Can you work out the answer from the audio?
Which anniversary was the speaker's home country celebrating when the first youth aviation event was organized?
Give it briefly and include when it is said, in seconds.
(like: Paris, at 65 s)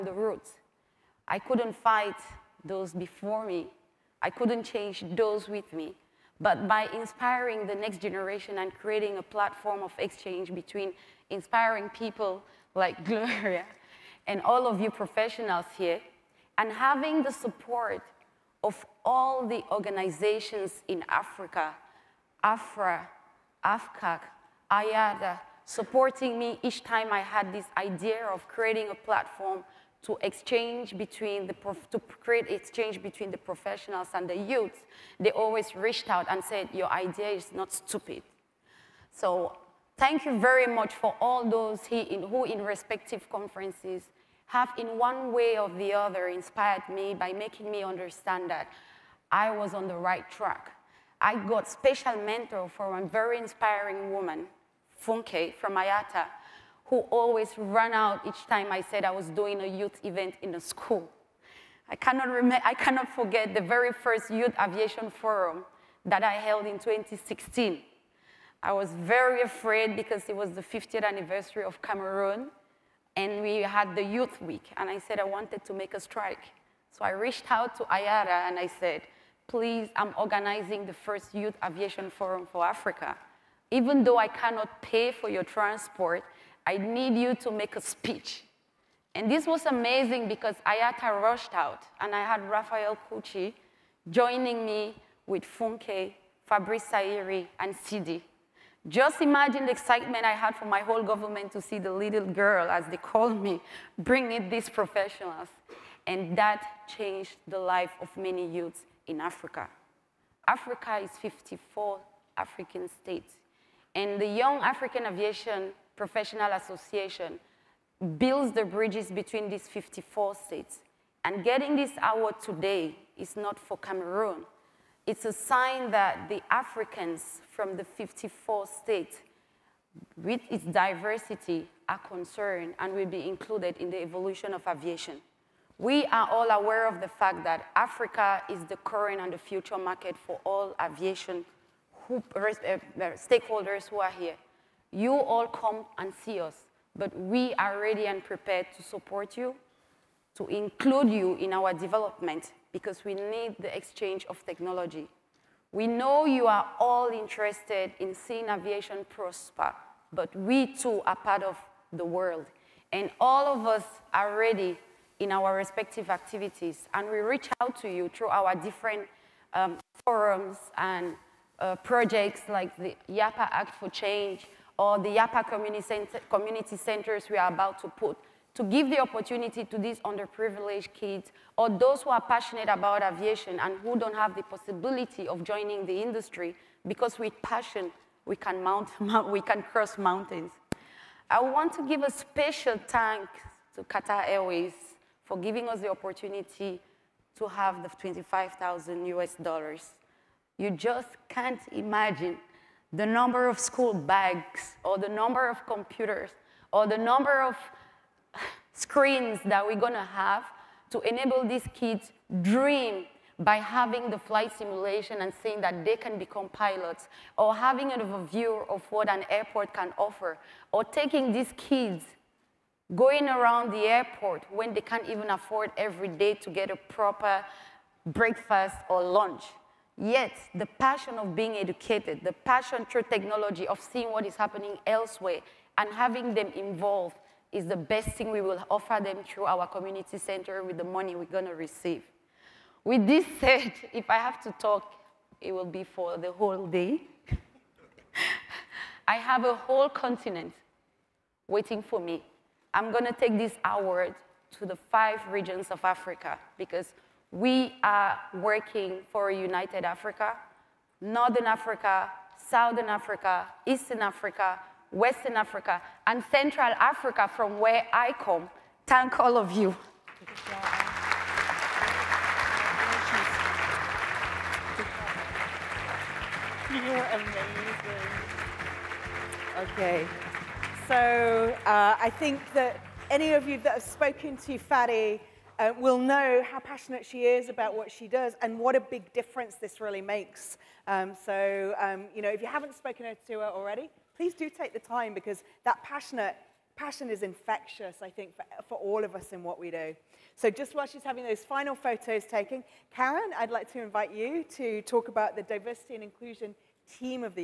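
50th, at 70 s.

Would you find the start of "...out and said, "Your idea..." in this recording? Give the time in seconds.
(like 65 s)
36 s.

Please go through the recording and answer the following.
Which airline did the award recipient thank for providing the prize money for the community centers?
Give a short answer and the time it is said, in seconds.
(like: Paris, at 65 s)
Qatar Airways, at 193 s.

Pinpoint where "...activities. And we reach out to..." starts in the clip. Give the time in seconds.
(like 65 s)
166 s.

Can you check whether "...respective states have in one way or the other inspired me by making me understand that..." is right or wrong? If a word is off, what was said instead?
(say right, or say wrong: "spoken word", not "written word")
wrong: "conferences", not "states".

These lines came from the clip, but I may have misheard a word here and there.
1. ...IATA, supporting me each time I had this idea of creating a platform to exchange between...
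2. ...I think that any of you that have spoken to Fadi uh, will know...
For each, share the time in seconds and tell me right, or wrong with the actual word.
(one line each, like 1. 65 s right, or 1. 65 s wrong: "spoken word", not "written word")
1. 24 s right
2. 282 s right.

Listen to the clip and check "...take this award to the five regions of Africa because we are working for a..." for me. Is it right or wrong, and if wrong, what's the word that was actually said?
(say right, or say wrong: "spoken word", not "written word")
right.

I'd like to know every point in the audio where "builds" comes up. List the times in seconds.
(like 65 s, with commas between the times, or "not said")
118 s.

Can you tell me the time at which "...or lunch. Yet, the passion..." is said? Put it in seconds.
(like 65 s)
228 s.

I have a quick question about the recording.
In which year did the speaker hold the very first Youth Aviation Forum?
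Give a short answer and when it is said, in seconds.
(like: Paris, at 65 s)
2016, at 66 s.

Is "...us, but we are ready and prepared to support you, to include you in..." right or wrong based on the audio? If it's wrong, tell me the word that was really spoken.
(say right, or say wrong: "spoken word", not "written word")
right.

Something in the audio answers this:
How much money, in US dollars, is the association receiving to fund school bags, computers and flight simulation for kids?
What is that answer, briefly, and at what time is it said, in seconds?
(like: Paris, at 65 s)
$25,000, at 197 s.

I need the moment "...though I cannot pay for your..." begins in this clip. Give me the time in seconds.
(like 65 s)
84 s.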